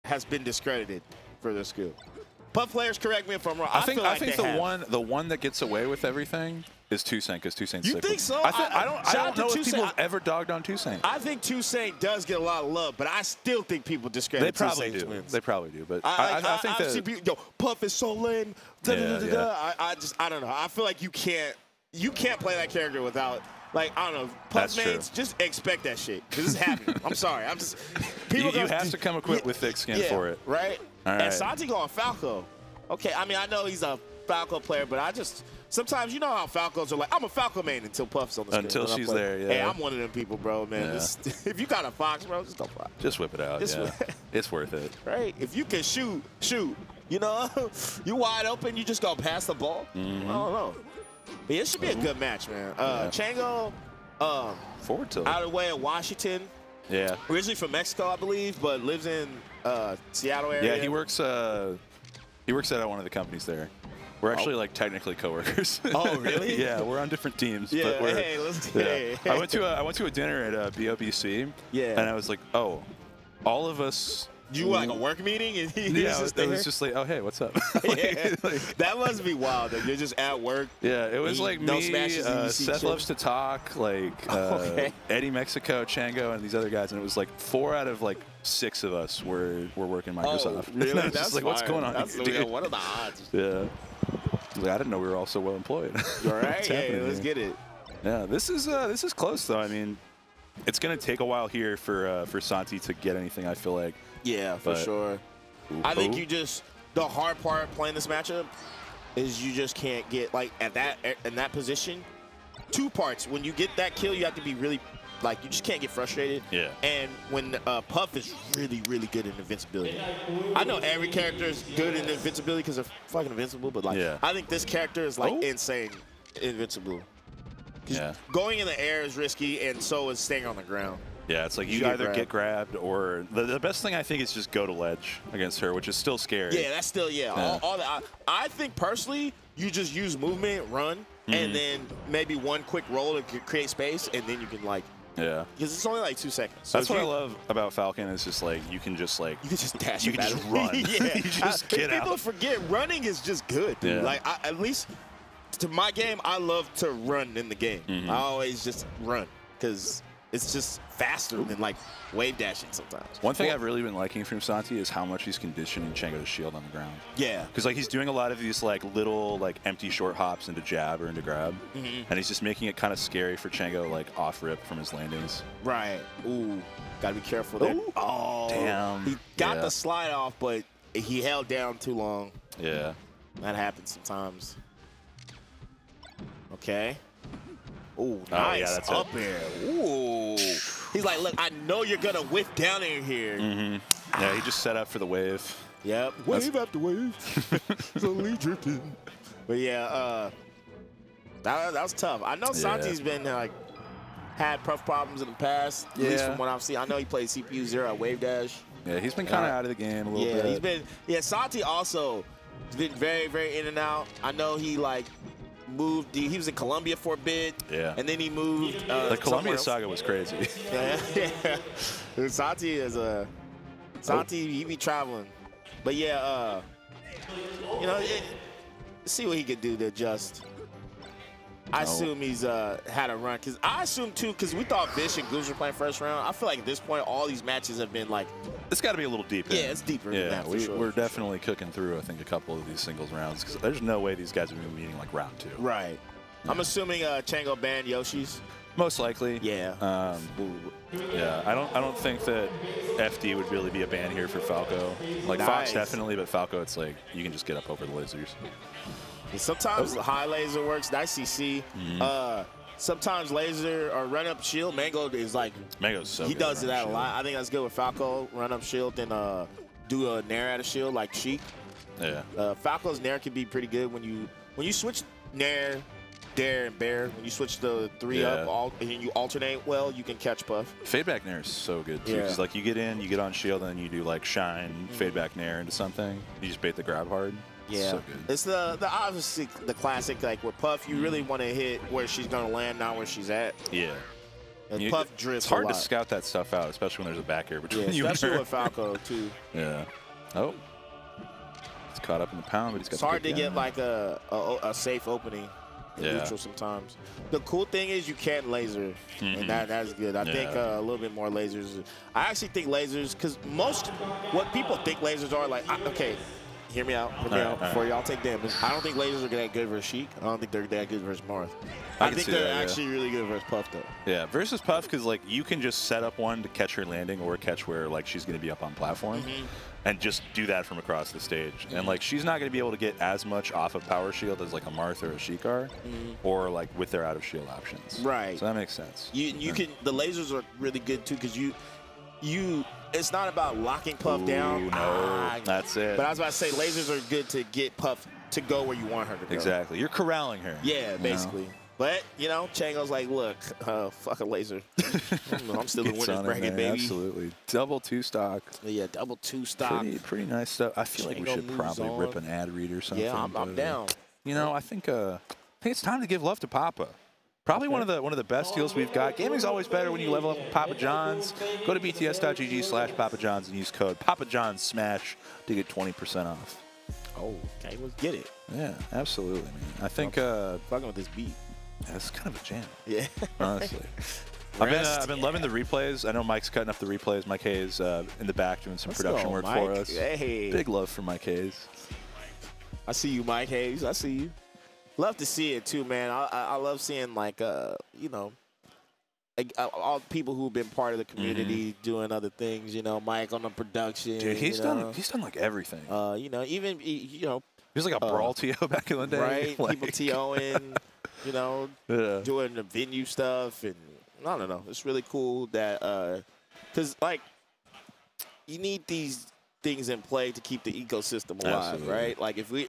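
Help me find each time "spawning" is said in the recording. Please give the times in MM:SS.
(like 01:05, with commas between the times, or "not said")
not said.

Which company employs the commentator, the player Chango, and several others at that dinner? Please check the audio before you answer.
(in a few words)
Microsoft.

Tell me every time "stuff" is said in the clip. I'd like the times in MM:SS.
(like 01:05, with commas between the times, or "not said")
04:56, 06:00, 06:53.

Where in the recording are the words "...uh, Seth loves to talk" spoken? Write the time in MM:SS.
01:22.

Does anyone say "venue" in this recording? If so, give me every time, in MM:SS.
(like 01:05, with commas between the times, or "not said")
06:52.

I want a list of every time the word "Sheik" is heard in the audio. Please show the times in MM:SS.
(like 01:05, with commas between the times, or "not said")
04:31, 05:19, 05:35.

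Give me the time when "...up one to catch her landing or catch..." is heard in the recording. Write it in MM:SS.
05:26.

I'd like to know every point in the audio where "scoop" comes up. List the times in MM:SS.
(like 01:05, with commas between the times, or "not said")
00:01.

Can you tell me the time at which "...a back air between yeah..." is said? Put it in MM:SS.
04:57.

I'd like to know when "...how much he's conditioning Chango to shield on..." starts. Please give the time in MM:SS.
02:44.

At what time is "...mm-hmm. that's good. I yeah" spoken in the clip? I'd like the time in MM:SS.
05:09.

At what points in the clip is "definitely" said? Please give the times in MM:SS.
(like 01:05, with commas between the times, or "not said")
04:00, 04:15.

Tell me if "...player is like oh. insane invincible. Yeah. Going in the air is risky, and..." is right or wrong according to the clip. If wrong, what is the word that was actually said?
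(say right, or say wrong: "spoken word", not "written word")
wrong: "character", not "player".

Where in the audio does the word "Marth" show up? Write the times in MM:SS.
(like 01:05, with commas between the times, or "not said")
05:21, 05:34.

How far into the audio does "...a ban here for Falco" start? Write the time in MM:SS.
04:13.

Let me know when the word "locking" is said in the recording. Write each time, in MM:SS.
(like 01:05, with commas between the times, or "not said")
05:43.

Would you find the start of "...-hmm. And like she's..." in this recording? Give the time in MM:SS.
05:31.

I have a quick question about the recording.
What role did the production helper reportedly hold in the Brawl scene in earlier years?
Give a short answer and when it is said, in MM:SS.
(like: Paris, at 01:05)
Brawl TO, at 06:48.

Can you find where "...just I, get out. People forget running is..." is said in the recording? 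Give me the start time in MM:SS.
02:31.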